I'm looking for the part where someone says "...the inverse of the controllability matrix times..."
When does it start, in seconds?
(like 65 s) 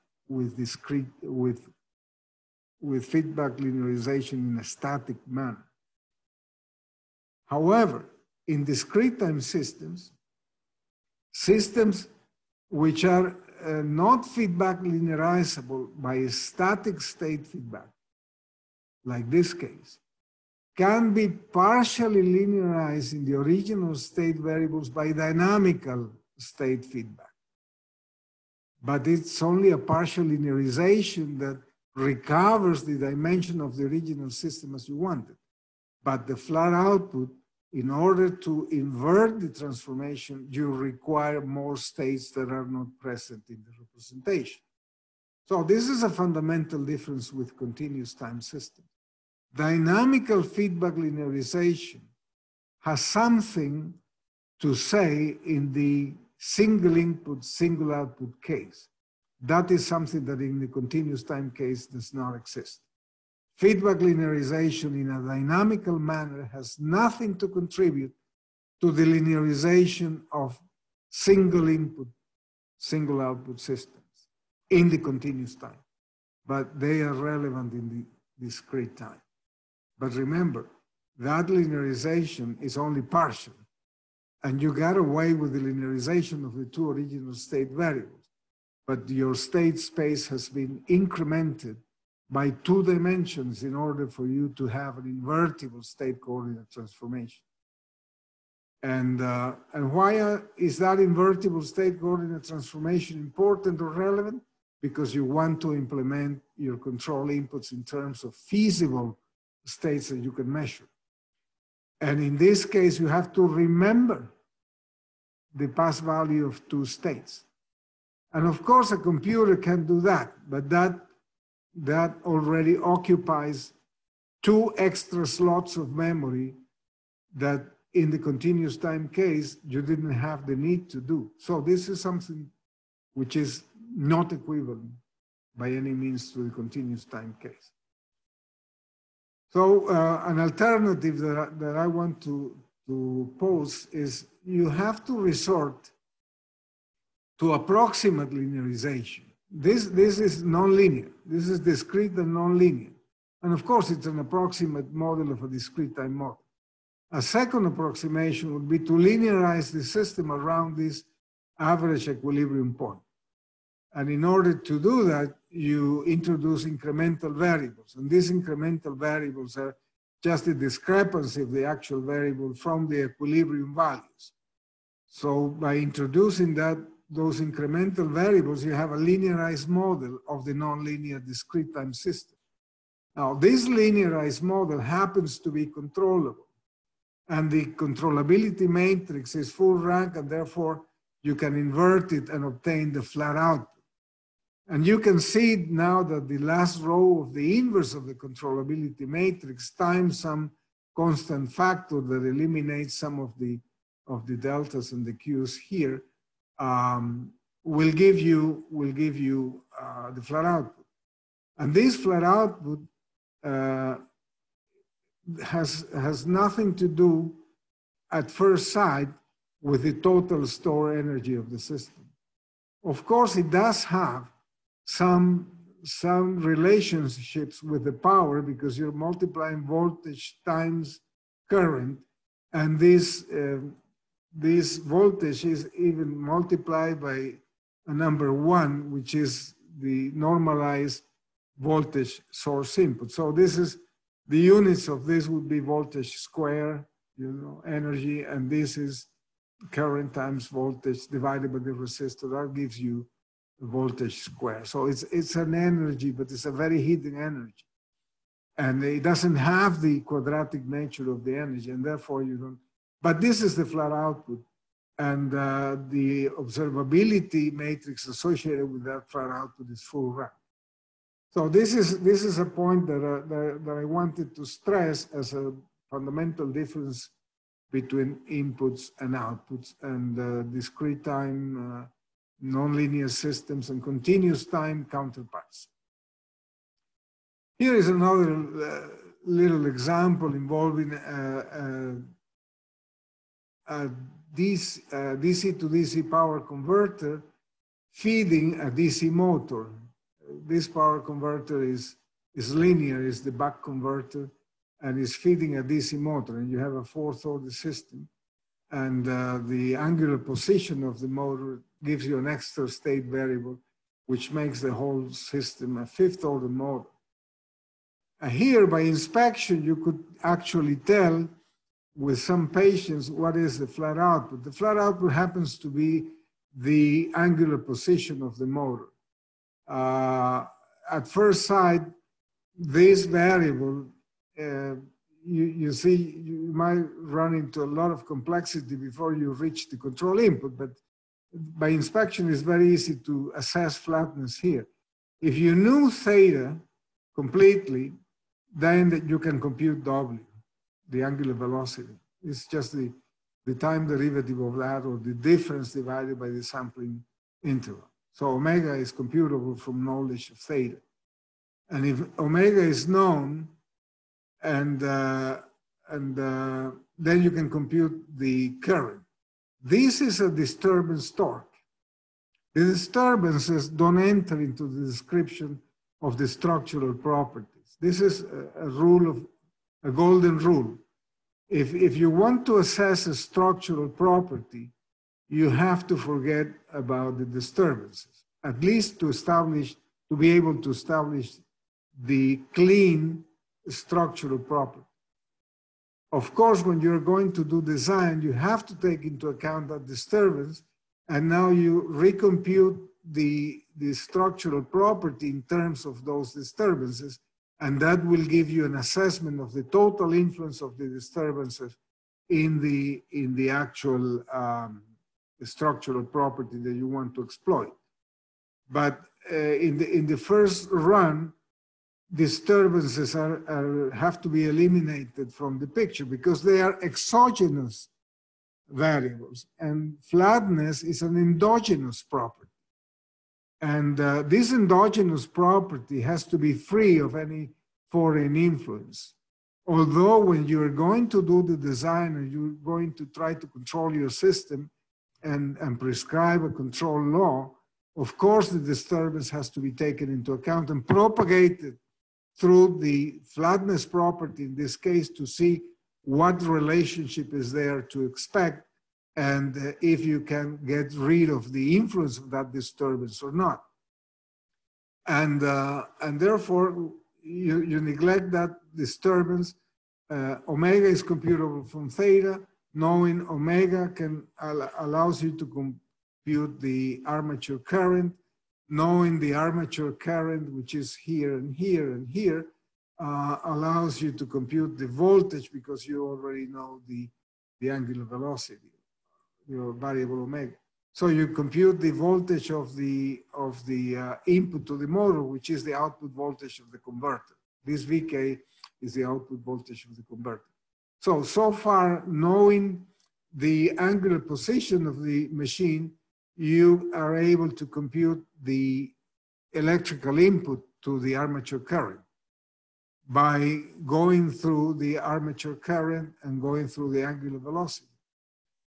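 197 s.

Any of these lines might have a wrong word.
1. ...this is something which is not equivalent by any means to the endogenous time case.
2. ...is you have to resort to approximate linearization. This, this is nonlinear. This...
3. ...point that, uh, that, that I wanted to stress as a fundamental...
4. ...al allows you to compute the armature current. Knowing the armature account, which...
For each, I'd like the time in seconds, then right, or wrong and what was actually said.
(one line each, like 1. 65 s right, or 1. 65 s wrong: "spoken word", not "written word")
1. 131 s wrong: "continuous", not "endogenous"
2. 143 s right
3. 272 s right
4. 474 s wrong: "current", not "account".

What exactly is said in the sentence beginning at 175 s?
So by introducing that those incremental variables, you have a linearized model of the nonlinear discrete time system.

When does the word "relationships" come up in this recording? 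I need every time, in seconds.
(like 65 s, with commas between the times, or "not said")
226 s, 456 s.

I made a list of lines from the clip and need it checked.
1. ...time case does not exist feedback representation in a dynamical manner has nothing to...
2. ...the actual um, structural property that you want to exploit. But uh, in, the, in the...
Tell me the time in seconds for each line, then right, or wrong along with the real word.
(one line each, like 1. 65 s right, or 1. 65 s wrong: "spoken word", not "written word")
1. 61 s wrong: "linearization", not "representation"
2. 413 s right.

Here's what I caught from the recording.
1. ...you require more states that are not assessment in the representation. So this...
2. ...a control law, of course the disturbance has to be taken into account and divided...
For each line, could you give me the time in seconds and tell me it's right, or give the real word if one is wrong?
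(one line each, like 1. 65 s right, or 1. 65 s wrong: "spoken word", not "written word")
1. 40 s wrong: "present", not "assessment"
2. 446 s wrong: "propagated", not "divided".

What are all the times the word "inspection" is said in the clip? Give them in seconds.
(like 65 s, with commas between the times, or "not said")
318 s, 341 s.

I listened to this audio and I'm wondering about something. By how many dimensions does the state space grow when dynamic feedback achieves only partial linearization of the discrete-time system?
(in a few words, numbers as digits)
2.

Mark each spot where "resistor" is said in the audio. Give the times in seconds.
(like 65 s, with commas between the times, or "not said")
251 s.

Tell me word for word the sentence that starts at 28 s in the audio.
But it's only a partial linearization that recovers the dimension of the original system as you wanted.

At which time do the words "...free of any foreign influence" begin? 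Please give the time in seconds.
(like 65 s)
436 s.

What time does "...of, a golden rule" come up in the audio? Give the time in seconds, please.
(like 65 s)
379 s.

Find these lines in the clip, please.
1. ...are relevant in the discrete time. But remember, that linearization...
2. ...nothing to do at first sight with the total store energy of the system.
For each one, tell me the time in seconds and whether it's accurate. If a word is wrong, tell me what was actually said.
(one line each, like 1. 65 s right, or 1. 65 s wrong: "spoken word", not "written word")
1. 77 s right
2. 216 s right.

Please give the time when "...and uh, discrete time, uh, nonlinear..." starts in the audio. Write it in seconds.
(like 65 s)
279 s.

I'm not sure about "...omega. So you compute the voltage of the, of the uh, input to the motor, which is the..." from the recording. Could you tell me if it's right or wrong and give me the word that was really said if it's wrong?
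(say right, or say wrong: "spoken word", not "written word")
right.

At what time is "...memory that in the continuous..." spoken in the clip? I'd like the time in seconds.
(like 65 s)
125 s.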